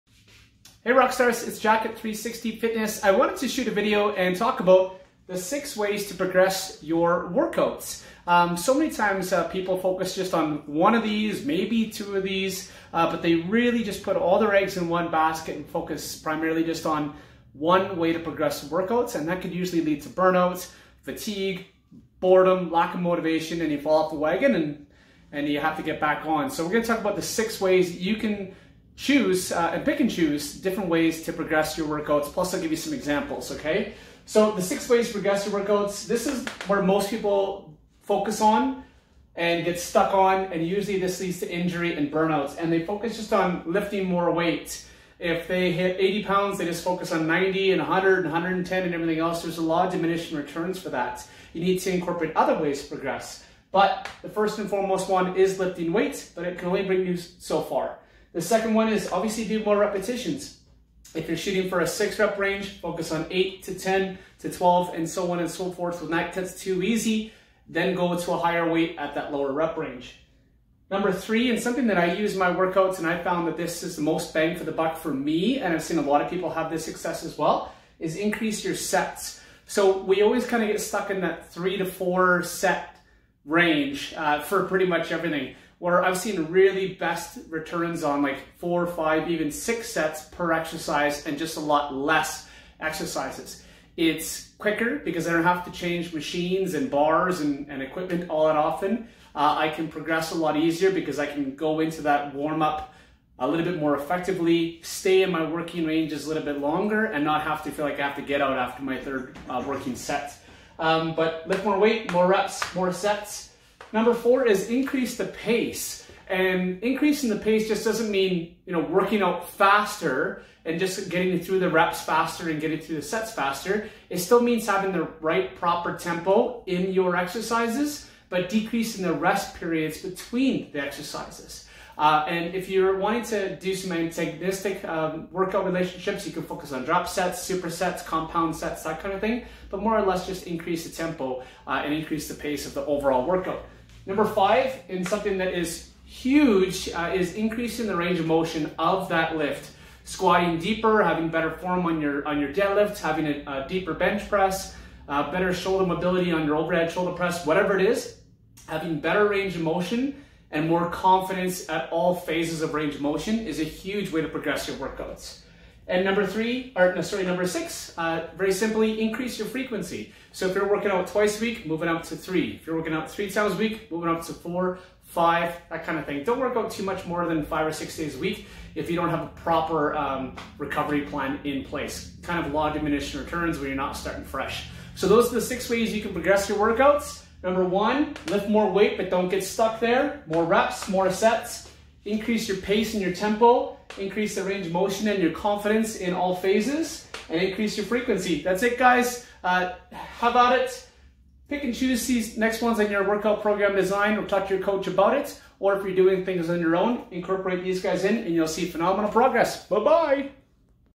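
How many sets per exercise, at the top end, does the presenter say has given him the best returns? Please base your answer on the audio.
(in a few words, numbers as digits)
6.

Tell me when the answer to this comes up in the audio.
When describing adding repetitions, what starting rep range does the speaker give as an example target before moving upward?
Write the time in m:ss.
1:01.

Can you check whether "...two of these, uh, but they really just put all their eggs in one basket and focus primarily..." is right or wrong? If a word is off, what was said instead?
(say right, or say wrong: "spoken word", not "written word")
right.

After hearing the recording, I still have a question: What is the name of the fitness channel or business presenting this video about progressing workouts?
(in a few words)
Jacket 360 Fitness.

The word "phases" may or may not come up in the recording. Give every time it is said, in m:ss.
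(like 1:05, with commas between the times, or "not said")
2:42, 3:16.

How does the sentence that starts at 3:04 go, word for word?
So those are the six ways you can progress your workouts.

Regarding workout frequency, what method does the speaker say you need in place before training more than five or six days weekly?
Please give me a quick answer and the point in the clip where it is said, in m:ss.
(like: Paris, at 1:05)
recovery plan, at 3:00.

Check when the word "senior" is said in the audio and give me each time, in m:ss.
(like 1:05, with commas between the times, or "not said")
not said.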